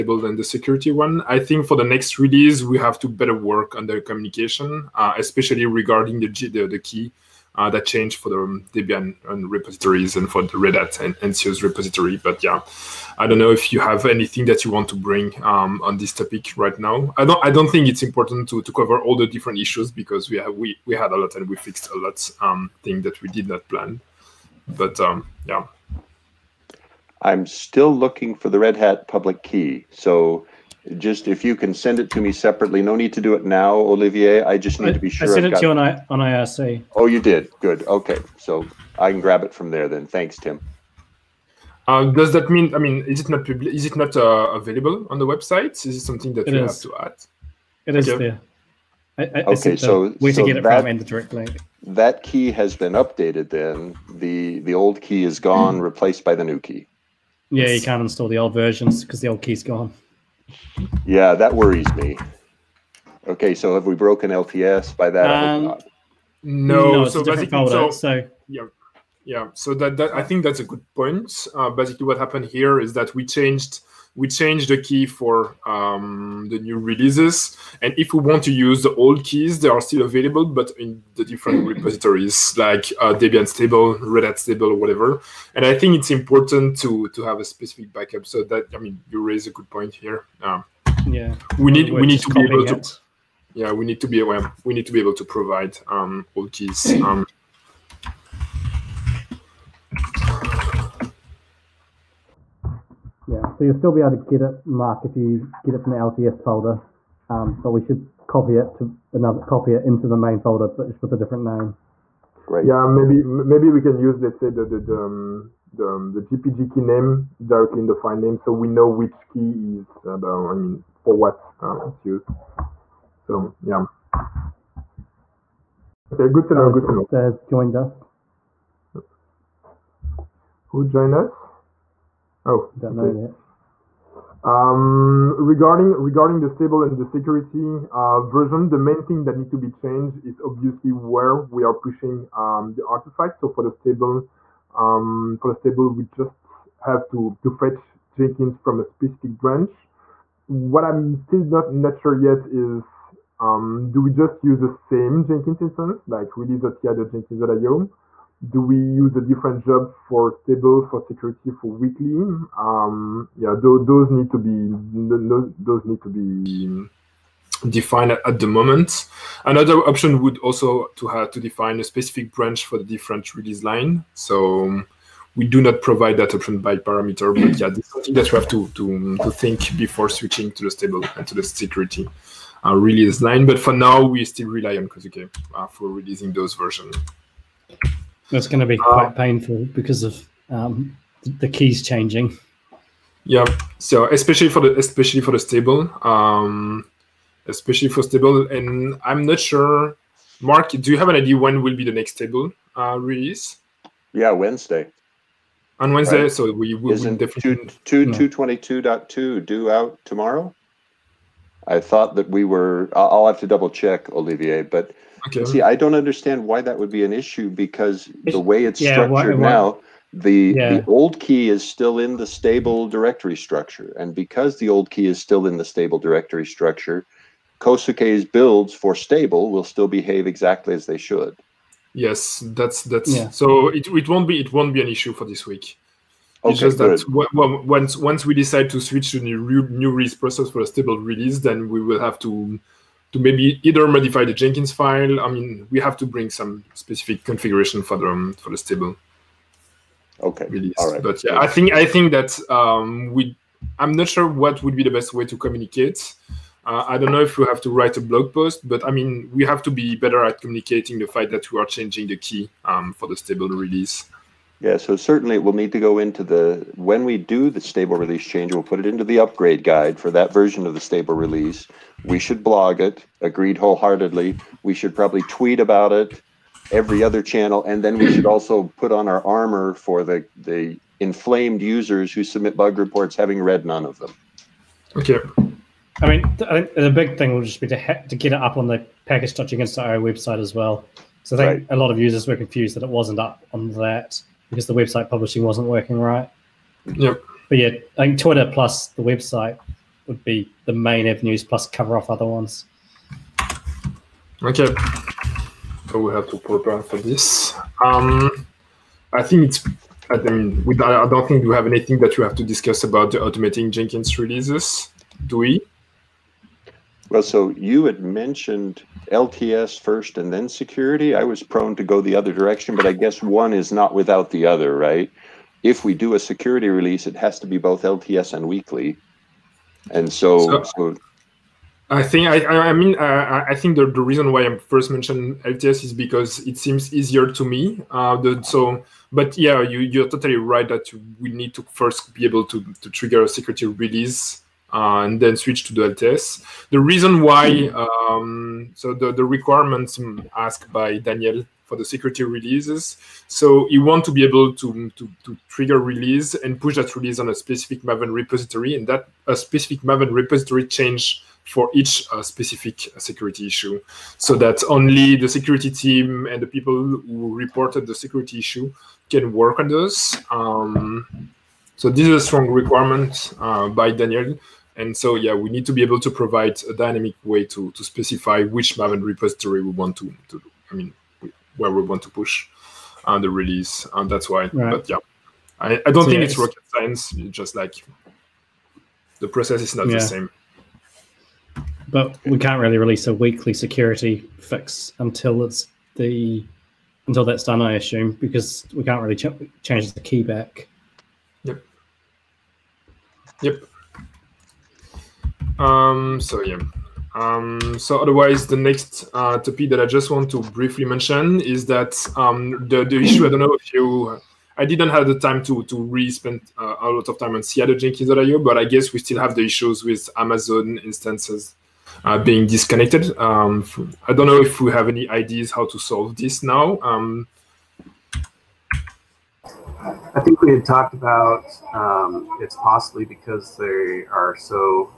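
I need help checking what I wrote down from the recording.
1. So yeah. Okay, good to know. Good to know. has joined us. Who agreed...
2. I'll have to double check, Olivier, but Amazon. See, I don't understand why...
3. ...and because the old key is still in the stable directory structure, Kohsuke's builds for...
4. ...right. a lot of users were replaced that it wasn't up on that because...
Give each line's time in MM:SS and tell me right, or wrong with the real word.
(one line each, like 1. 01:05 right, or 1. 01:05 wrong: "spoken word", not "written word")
1. 02:03 wrong: "joined", not "agreed"
2. 03:32 wrong: "Okay", not "Amazon"
3. 03:43 right
4. 04:51 wrong: "confused", not "replaced".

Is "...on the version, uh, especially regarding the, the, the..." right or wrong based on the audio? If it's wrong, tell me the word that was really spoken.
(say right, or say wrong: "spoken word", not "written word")
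wrong: "communication", not "version".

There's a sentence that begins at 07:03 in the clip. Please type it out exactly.
Um, I don't know if we have any ideas how to solve this now.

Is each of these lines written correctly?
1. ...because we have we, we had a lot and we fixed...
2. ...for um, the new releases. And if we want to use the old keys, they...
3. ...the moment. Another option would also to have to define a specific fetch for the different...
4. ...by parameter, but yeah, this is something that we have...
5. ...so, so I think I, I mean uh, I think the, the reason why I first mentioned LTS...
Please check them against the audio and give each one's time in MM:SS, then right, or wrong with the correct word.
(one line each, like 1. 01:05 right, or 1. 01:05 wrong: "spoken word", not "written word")
1. 00:19 right
2. 01:15 right
3. 02:48 wrong: "branch", not "fetch"
4. 02:56 right
5. 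05:30 right.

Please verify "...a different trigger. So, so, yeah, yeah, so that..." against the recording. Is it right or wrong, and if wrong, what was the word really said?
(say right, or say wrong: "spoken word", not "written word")
wrong: "folder", not "trigger".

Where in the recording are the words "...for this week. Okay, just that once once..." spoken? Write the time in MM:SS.
03:55.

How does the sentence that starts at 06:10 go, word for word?
Um, so this is a strong requirement uh, by Daniel.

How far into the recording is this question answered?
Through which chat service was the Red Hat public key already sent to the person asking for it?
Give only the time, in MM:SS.
00:36.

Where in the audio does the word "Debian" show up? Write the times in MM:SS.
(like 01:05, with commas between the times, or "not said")
00:08, 01:23.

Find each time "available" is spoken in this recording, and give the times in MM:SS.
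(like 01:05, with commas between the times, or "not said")
00:44, 01:20.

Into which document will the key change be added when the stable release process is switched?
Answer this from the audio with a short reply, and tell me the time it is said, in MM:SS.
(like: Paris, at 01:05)
upgrade guide, at 04:29.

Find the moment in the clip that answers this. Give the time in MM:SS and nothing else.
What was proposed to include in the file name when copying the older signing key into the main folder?
01:56.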